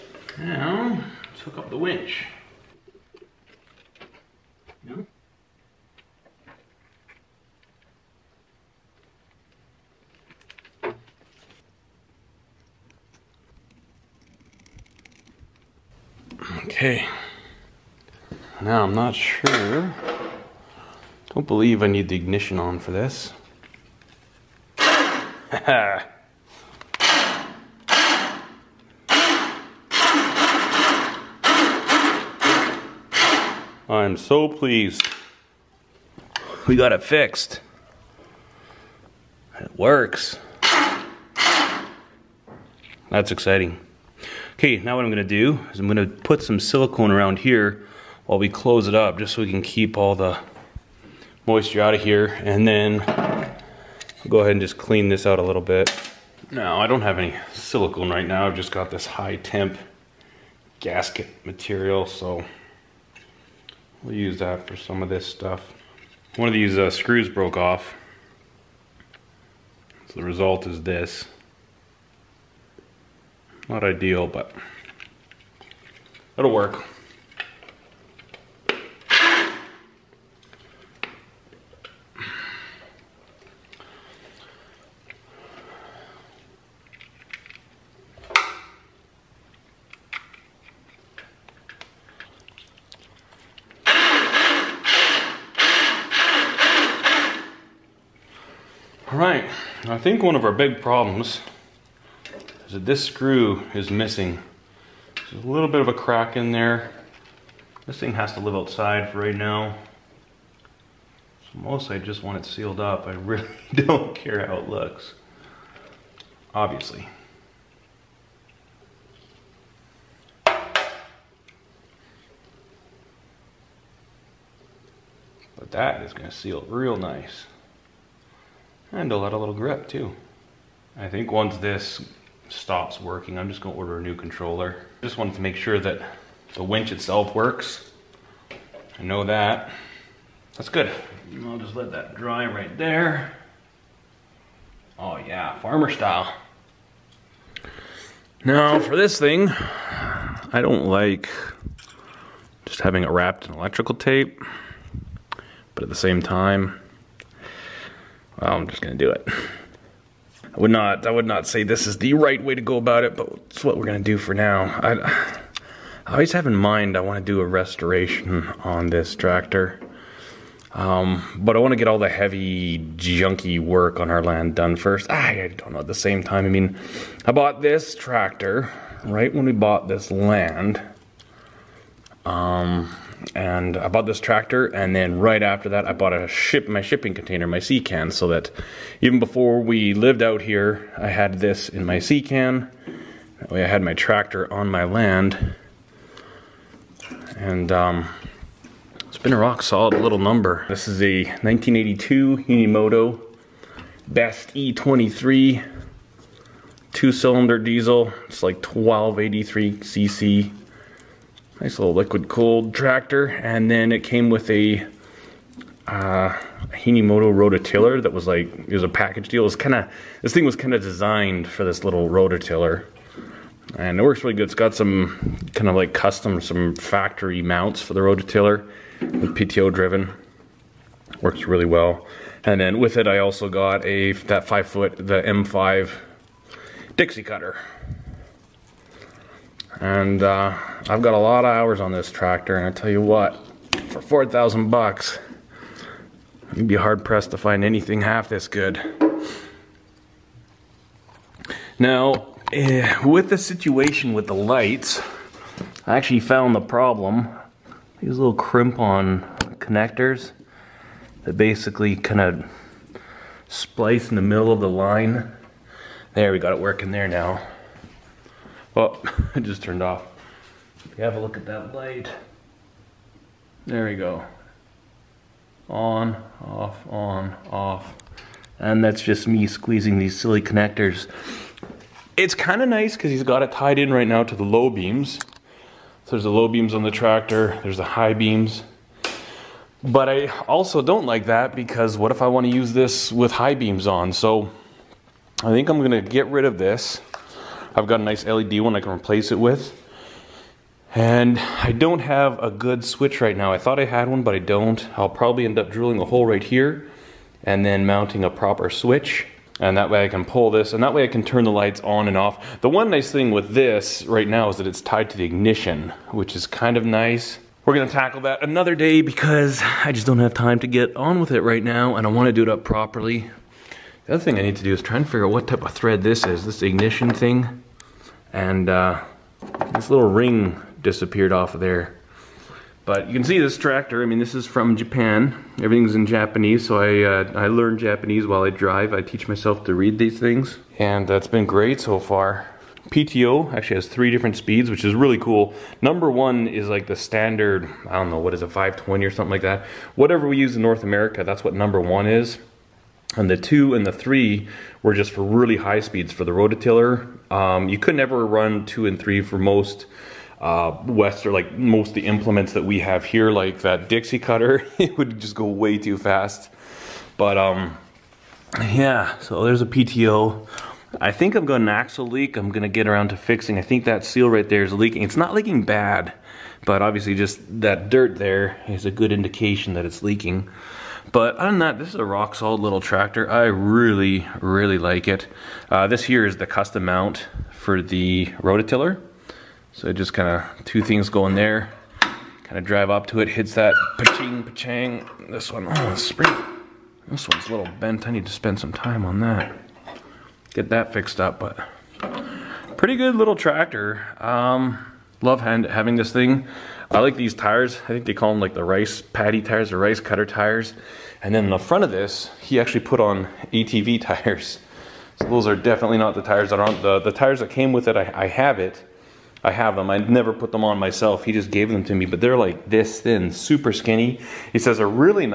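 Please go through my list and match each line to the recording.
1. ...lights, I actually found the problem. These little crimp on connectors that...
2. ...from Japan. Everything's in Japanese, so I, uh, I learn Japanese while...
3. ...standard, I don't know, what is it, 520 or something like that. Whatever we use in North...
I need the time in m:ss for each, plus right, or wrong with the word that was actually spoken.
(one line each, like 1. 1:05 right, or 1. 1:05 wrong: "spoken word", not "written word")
1. 4:14 right
2. 5:34 right
3. 5:46 right.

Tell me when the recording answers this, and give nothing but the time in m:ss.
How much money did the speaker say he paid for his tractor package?
4:04.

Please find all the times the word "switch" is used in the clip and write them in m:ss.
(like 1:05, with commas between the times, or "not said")
5:02, 5:08.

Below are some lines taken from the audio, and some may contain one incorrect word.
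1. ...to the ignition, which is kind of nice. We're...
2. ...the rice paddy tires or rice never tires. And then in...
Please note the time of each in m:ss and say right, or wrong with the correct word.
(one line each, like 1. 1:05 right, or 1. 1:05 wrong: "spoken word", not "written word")
1. 5:15 right
2. 6:48 wrong: "cutter", not "never".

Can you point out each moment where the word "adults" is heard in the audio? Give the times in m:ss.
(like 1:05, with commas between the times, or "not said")
not said.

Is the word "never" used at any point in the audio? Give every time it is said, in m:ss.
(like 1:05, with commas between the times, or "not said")
5:57, 6:59.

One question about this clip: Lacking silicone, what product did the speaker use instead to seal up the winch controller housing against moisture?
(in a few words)
high temp gasket material.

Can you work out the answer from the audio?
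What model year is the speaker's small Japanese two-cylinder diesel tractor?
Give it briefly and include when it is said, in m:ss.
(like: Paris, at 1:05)
1982, at 3:21.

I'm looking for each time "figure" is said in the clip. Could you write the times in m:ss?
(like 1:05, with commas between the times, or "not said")
5:25.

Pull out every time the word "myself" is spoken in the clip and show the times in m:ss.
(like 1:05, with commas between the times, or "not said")
5:39, 7:00.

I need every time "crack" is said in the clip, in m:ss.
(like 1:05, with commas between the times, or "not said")
1:45.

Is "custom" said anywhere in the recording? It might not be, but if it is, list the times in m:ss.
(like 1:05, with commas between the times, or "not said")
3:45, 6:26.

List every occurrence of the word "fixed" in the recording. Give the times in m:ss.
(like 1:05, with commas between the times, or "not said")
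0:37, 6:40.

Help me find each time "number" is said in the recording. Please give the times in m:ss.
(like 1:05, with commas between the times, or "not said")
3:20, 5:45, 5:51.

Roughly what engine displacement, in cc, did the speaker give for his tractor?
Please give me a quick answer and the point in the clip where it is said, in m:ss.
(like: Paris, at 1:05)
1283 cc, at 3:28.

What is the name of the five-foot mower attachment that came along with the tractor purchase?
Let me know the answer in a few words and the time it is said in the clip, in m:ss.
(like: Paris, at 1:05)
M5 Dixie cutter, at 3:55.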